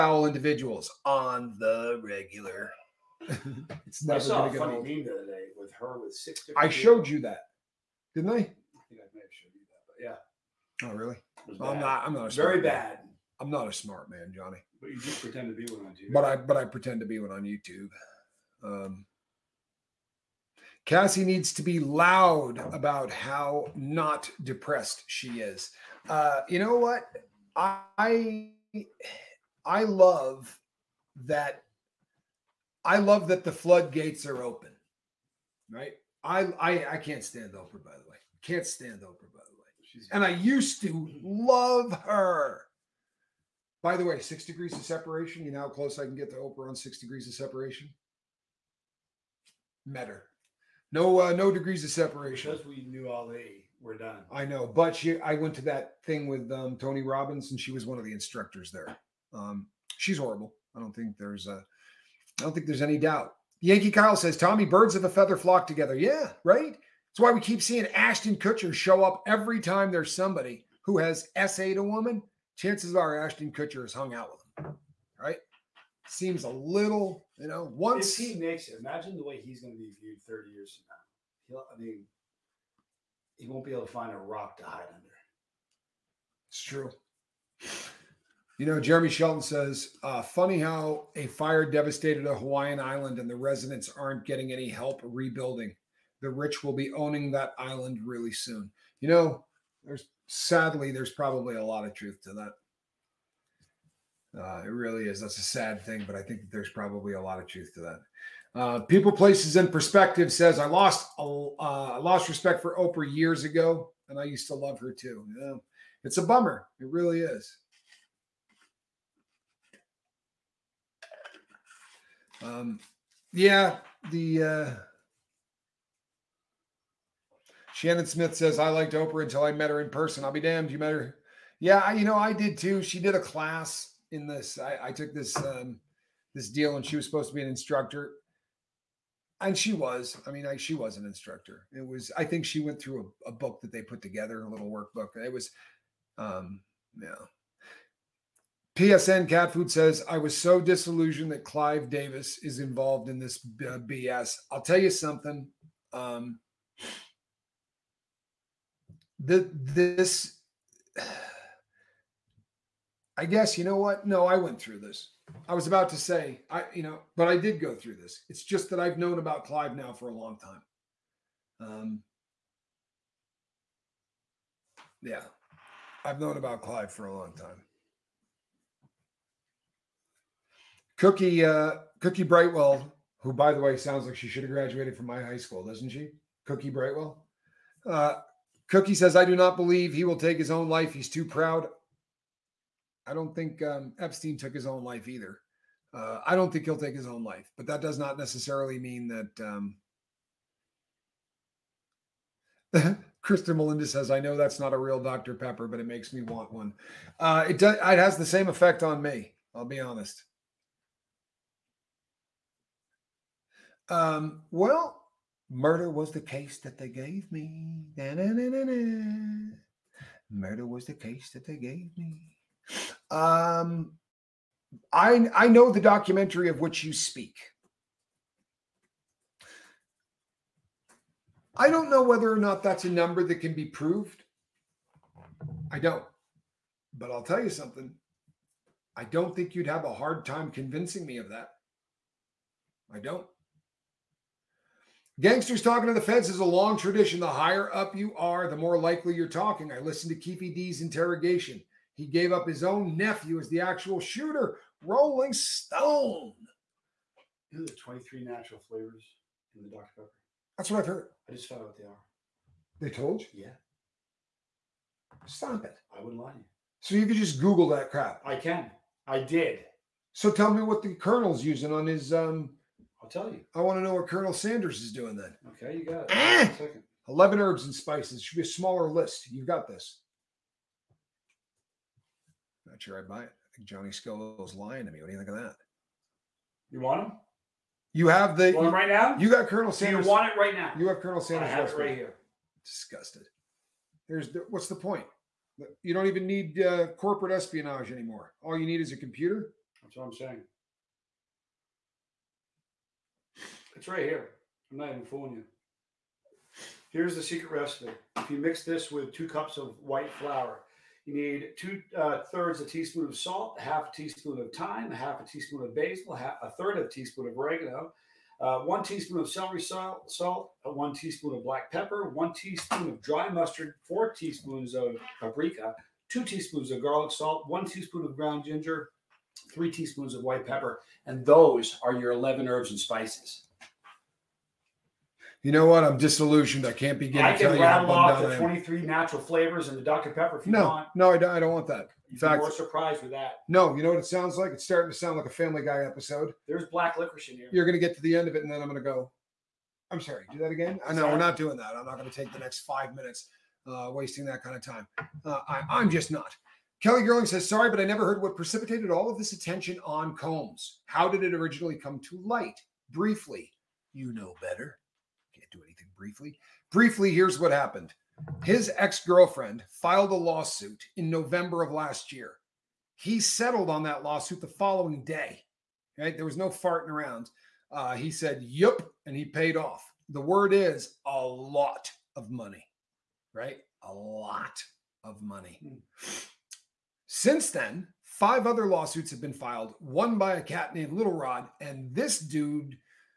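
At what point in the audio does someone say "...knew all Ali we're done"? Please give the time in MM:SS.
00:52.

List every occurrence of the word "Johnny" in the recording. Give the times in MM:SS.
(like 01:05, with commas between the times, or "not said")
00:14, 04:43.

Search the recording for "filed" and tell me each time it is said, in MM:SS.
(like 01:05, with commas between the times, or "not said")
06:09, 06:29.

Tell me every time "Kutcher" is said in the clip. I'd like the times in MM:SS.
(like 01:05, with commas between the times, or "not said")
01:08, 01:13.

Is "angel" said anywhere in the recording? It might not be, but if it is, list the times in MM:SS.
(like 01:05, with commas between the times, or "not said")
not said.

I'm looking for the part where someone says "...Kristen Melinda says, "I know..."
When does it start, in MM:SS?
03:23.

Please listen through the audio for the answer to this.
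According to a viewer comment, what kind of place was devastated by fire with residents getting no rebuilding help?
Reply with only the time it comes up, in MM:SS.
01:32.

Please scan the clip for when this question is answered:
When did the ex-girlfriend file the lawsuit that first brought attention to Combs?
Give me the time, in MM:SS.
06:11.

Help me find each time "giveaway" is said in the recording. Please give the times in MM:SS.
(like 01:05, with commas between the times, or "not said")
not said.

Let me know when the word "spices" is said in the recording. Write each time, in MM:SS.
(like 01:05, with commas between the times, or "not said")
04:37, 05:32.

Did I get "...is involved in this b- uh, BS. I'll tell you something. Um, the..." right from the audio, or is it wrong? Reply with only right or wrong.
right.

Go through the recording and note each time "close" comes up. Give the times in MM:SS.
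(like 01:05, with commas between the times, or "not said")
00:45.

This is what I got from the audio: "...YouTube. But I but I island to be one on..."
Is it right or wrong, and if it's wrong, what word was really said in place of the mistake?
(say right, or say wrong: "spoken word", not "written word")
wrong: "pretend", not "island".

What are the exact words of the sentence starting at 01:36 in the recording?
The rich will be owning that island really soon.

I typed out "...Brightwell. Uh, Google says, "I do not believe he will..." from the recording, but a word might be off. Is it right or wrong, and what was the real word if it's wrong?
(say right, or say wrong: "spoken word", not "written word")
wrong: "Cookie", not "Google".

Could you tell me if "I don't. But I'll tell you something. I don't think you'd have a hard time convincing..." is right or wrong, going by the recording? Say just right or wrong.
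right.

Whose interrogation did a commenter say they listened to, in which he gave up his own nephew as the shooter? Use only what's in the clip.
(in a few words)
Keefe D.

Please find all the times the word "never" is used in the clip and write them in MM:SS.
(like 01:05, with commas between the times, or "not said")
00:04, 05:57.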